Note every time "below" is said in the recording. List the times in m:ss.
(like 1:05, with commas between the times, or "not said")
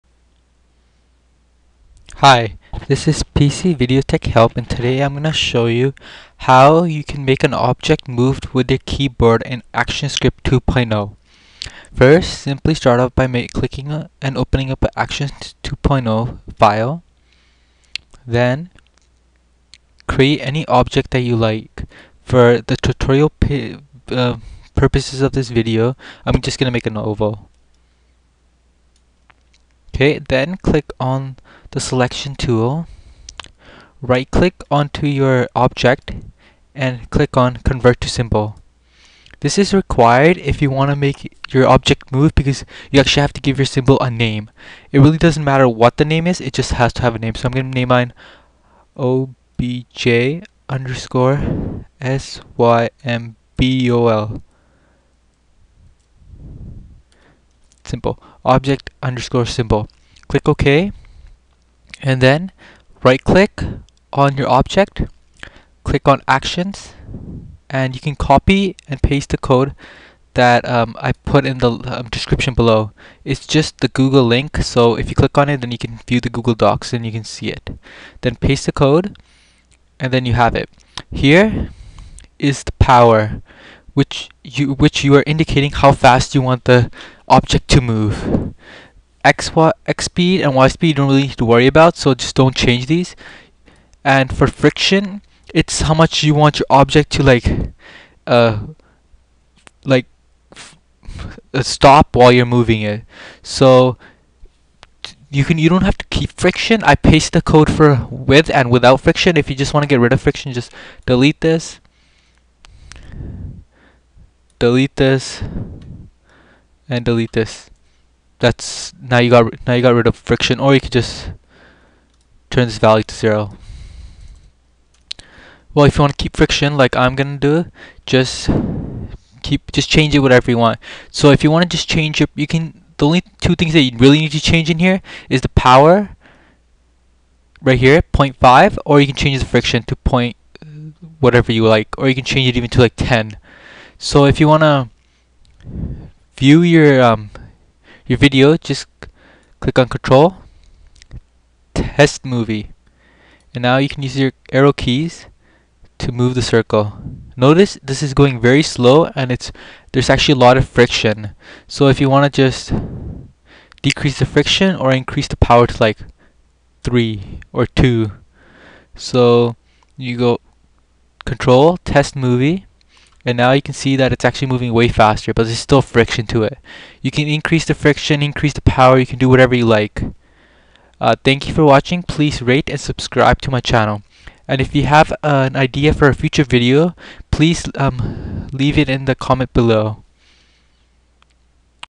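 1:12, 3:09.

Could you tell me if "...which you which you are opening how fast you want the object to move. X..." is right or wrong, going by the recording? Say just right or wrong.
wrong.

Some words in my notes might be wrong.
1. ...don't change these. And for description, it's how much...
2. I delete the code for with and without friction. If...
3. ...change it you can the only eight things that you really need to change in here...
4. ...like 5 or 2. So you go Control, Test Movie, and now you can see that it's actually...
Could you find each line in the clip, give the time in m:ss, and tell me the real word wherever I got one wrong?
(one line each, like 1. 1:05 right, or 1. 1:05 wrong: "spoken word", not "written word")
1. 1:32 wrong: "friction", not "description"
2. 1:46 wrong: "paste", not "delete"
3. 2:11 wrong: "two", not "eight"
4. 2:45 wrong: "3", not "5".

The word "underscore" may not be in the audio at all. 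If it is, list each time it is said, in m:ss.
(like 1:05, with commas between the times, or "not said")
0:50, 0:59.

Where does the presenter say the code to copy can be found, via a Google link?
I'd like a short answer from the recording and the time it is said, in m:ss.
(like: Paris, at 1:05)
Google Docs, at 1:16.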